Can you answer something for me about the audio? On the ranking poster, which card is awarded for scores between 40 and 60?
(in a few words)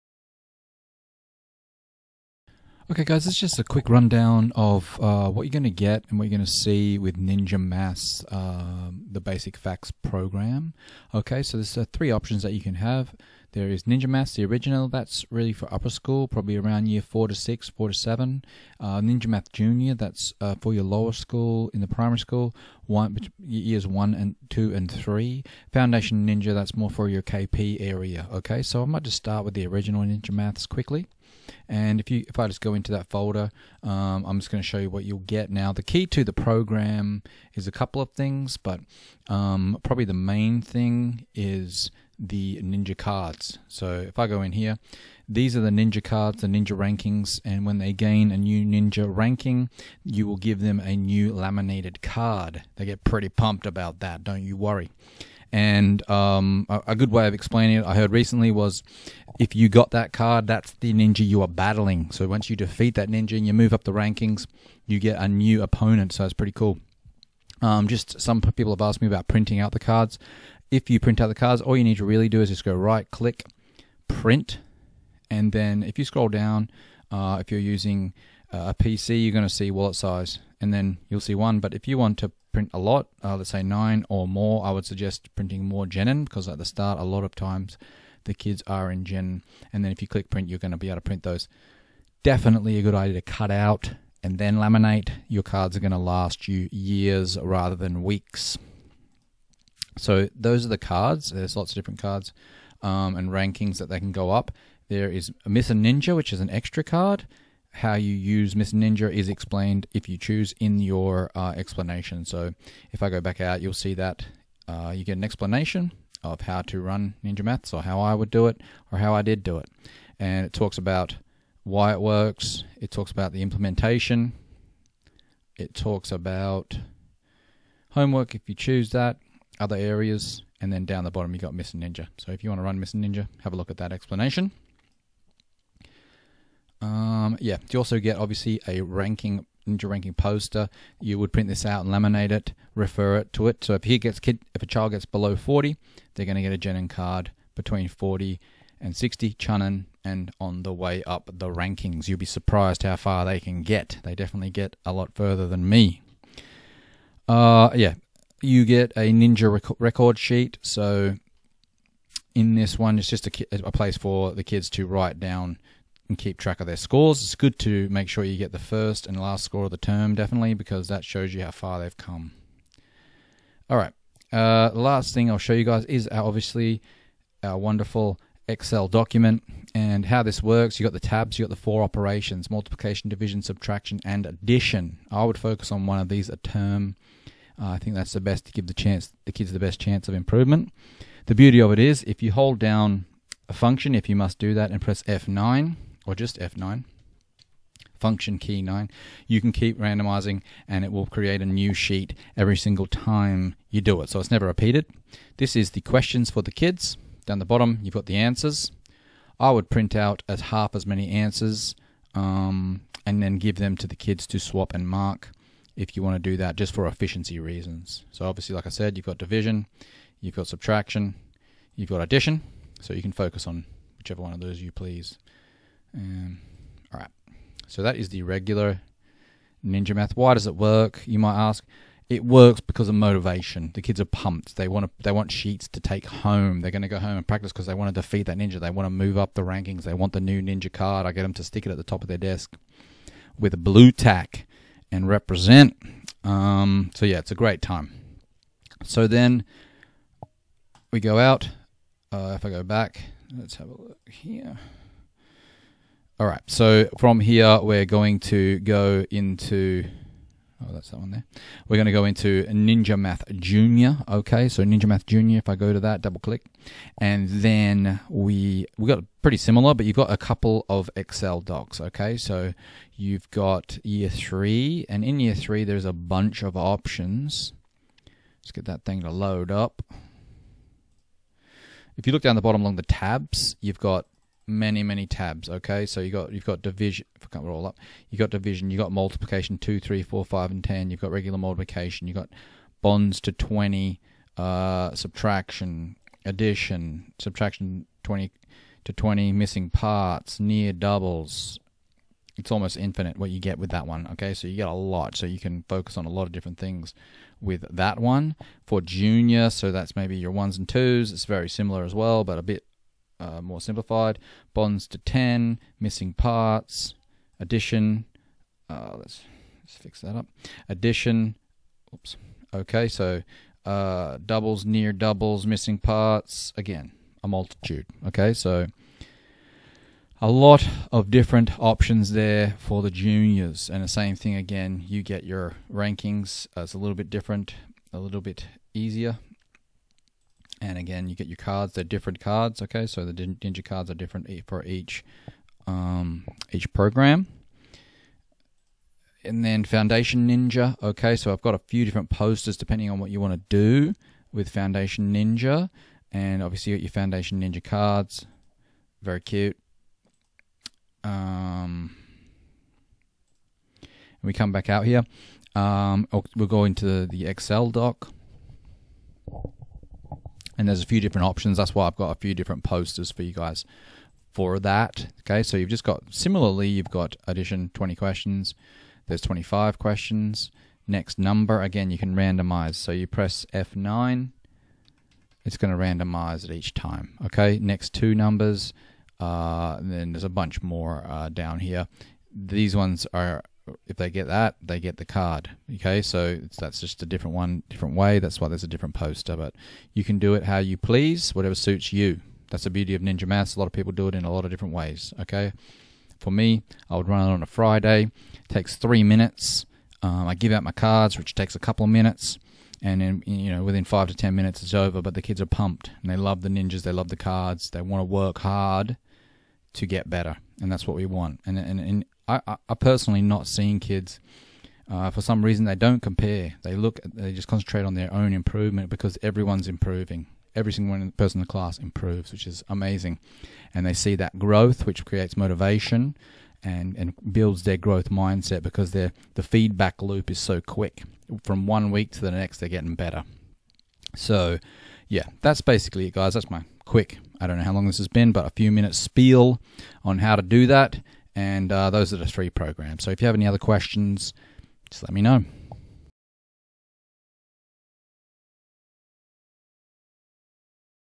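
Chunin.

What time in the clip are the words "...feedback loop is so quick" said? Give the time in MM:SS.
07:19.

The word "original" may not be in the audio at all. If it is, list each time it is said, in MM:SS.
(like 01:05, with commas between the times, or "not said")
00:14, 00:29.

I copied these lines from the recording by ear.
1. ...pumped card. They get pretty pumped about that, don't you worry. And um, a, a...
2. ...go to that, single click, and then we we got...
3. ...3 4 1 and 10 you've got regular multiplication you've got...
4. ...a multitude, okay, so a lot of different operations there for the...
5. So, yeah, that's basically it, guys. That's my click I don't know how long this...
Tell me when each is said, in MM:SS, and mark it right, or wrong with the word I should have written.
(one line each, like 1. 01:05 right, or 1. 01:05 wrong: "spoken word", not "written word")
1. 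00:51 wrong: "laminated", not "pumped"
2. 04:25 wrong: "double", not "single"
3. 04:49 wrong: "5", not "1"
4. 05:27 wrong: "options", not "operations"
5. 07:24 wrong: "quick", not "click".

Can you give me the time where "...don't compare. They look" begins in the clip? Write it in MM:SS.
07:05.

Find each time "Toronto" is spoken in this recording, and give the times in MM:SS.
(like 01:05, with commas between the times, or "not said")
not said.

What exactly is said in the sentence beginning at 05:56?
And obviously, you got your Foundation Ninja cards.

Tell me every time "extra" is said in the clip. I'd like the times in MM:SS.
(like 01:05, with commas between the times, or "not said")
01:46.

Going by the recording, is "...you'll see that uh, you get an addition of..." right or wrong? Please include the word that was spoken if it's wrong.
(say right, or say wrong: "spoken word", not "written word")
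wrong: "explanation", not "addition".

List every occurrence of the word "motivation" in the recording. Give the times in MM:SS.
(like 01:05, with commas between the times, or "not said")
03:52, 07:15.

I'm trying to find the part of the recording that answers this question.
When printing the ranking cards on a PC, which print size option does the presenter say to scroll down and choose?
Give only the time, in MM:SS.
01:19.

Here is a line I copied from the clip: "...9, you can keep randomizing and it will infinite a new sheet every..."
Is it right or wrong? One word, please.
wrong.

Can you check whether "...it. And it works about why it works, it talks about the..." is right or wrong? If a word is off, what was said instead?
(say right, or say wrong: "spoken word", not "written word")
wrong: "talks", not "works".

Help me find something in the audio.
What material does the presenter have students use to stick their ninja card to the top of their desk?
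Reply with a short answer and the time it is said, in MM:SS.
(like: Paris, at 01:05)
Blu Tack, at 04:03.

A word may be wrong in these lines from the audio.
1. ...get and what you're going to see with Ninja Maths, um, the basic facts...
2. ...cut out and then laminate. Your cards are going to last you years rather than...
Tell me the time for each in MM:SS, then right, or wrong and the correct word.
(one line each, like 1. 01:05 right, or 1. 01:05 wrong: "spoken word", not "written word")
1. 00:05 right
2. 01:33 right.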